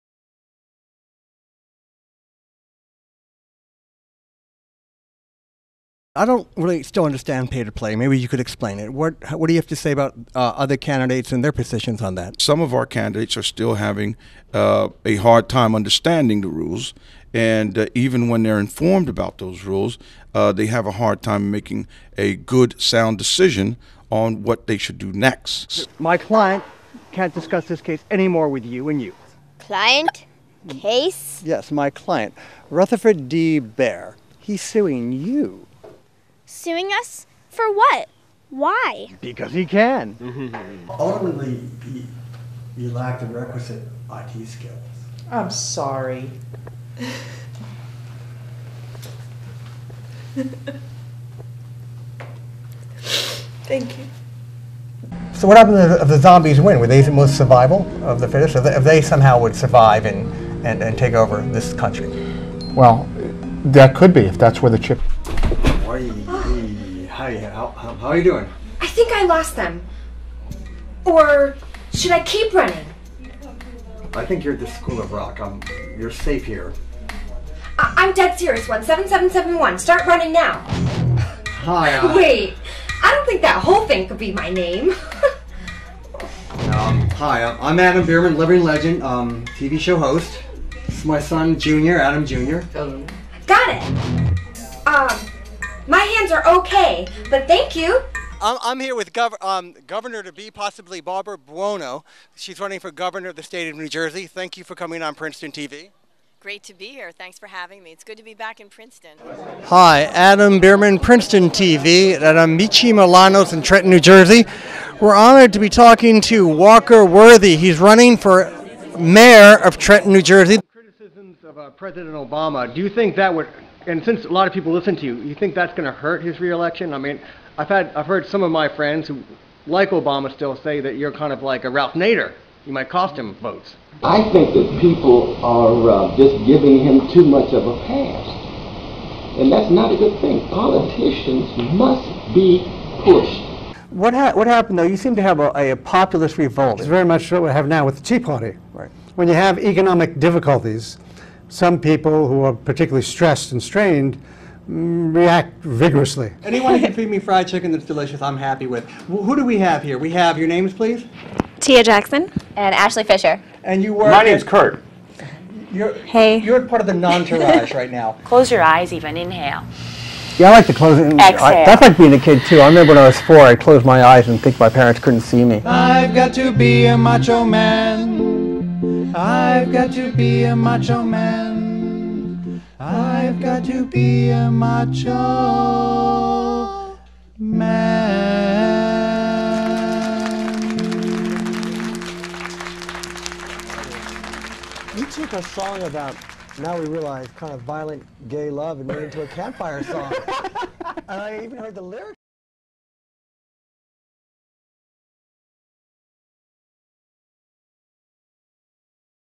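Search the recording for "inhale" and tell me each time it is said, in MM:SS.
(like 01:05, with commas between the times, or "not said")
02:49.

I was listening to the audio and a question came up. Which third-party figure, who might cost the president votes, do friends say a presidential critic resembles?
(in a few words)
Ralph Nader.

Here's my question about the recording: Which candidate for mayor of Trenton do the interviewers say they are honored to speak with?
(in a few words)
Walker Worthy.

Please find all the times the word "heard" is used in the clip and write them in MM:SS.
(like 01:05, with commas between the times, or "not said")
02:08, 03:21.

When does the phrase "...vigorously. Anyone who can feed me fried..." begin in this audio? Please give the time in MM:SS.
02:35.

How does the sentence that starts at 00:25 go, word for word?
My client can't discuss this case anymore with you and you.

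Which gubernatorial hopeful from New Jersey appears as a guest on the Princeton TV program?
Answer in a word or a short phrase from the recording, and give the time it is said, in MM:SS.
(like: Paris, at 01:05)
Barbara Buono, at 01:41.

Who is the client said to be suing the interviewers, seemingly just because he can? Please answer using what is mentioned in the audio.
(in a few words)
Rutherford D. Bear.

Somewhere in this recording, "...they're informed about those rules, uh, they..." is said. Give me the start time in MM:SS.
00:18.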